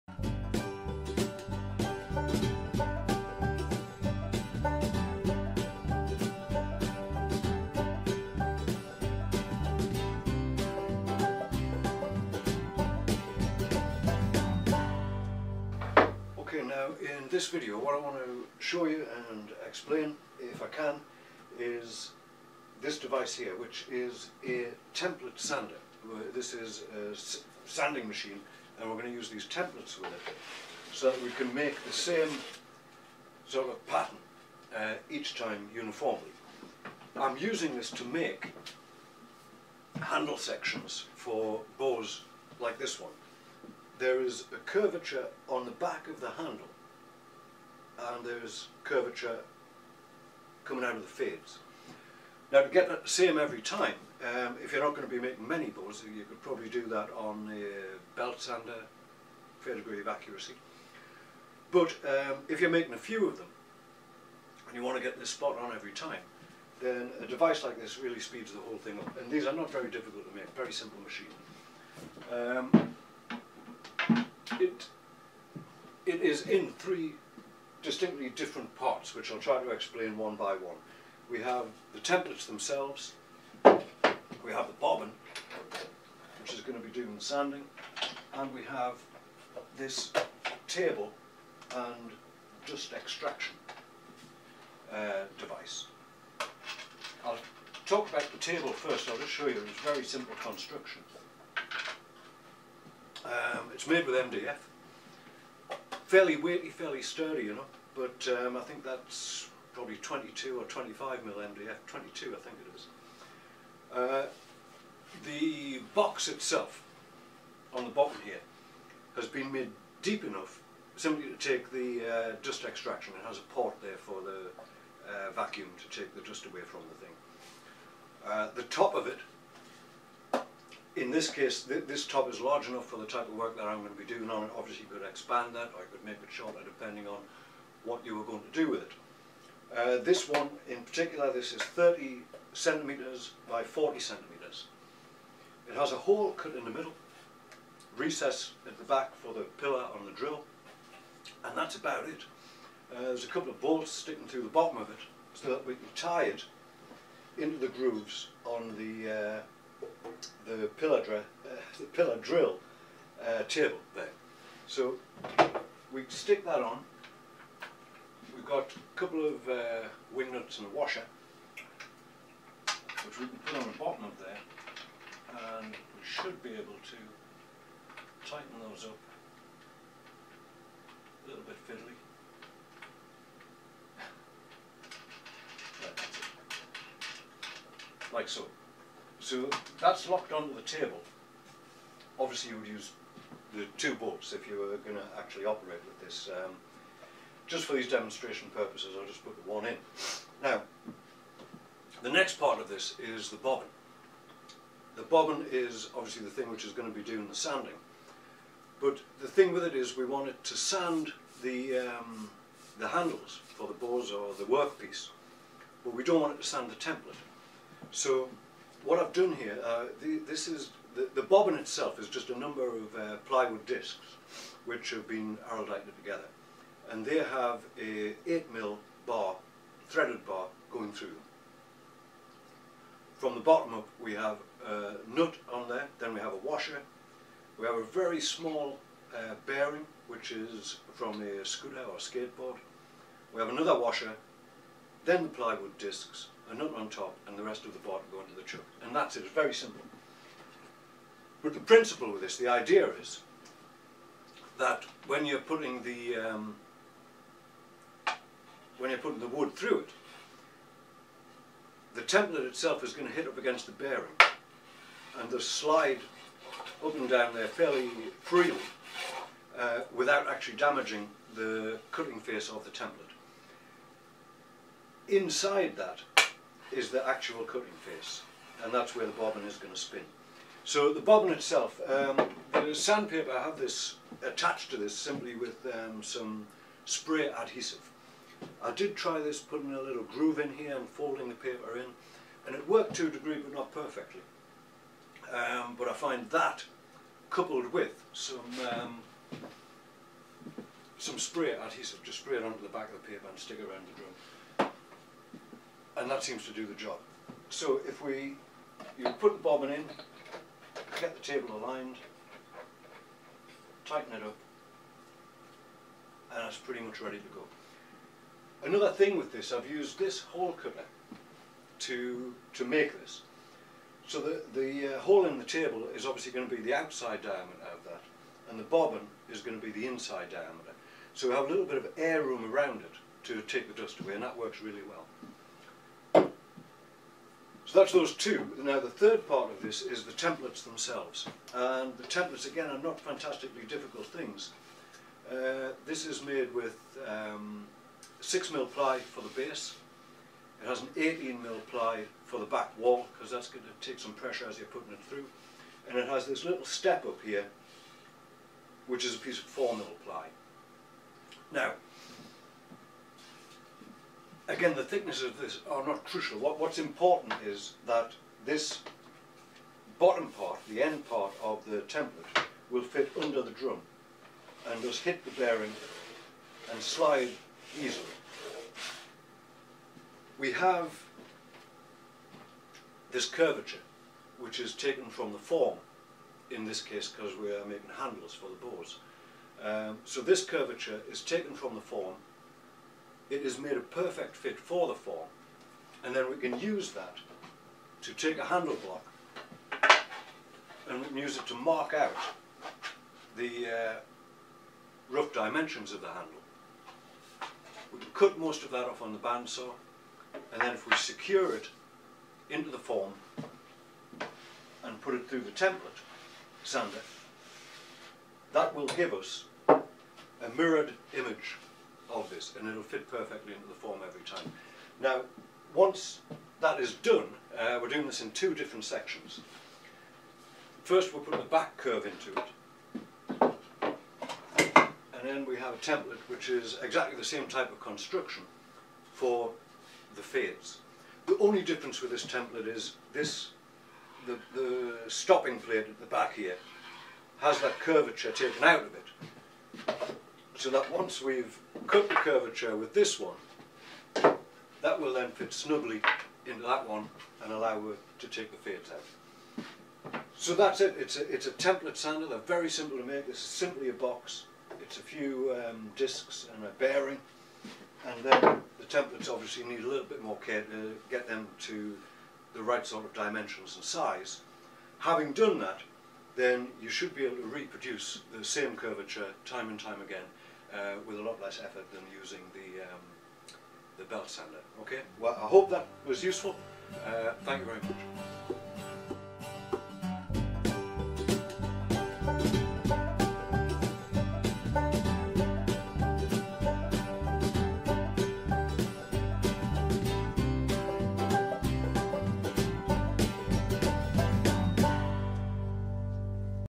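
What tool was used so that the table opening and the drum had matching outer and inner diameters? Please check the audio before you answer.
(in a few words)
hole cutter.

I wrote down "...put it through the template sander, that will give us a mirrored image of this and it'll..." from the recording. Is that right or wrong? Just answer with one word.
right.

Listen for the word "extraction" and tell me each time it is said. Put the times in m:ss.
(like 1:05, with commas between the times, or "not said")
1:32, 2:02.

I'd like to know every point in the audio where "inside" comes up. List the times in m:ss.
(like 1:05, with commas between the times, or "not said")
4:35, 5:29.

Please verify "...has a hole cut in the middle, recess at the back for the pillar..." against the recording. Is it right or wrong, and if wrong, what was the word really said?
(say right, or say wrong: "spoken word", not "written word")
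right.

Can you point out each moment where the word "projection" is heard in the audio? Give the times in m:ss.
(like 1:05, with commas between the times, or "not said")
not said.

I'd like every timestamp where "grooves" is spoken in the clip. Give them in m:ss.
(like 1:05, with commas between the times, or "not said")
2:37, 4:50.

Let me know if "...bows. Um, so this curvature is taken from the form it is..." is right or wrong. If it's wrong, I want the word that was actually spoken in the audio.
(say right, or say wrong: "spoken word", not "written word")
right.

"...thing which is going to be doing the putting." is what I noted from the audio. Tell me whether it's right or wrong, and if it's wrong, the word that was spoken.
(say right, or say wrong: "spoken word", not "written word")
wrong: "sanding", not "putting".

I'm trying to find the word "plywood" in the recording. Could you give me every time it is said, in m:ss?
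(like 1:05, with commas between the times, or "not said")
3:43, 4:05.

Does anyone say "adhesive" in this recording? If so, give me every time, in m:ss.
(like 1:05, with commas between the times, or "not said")
4:47, 5:01.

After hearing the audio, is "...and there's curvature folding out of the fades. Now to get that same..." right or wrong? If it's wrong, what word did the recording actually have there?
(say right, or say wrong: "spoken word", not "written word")
wrong: "coming", not "folding".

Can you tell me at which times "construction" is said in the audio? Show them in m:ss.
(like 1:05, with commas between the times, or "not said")
1:40, 7:17.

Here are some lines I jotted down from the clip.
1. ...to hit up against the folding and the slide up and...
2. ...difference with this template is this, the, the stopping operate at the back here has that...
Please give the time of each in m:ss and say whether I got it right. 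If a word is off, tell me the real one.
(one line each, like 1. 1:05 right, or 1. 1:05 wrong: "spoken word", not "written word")
1. 4:23 wrong: "bearing", not "folding"
2. 7:21 wrong: "plate", not "operate".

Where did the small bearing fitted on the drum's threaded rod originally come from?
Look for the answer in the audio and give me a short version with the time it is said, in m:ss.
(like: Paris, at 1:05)
scooter or skateboard, at 4:01.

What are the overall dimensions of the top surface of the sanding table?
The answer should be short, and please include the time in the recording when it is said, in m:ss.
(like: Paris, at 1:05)
30 cm by 40 cm, at 2:21.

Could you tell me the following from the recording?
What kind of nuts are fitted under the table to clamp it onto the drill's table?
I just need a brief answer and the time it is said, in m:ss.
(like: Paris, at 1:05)
wing nuts, at 2:50.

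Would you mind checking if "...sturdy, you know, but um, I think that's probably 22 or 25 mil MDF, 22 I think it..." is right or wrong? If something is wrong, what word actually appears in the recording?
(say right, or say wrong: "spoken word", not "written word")
right.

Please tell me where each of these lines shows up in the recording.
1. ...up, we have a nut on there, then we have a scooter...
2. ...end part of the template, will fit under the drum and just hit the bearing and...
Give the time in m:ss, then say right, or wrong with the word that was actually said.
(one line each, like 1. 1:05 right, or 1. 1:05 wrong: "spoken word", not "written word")
1. 3:53 wrong: "washer", not "scooter"
2. 6:10 right.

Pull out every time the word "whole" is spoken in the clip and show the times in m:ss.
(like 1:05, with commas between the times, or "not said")
1:08.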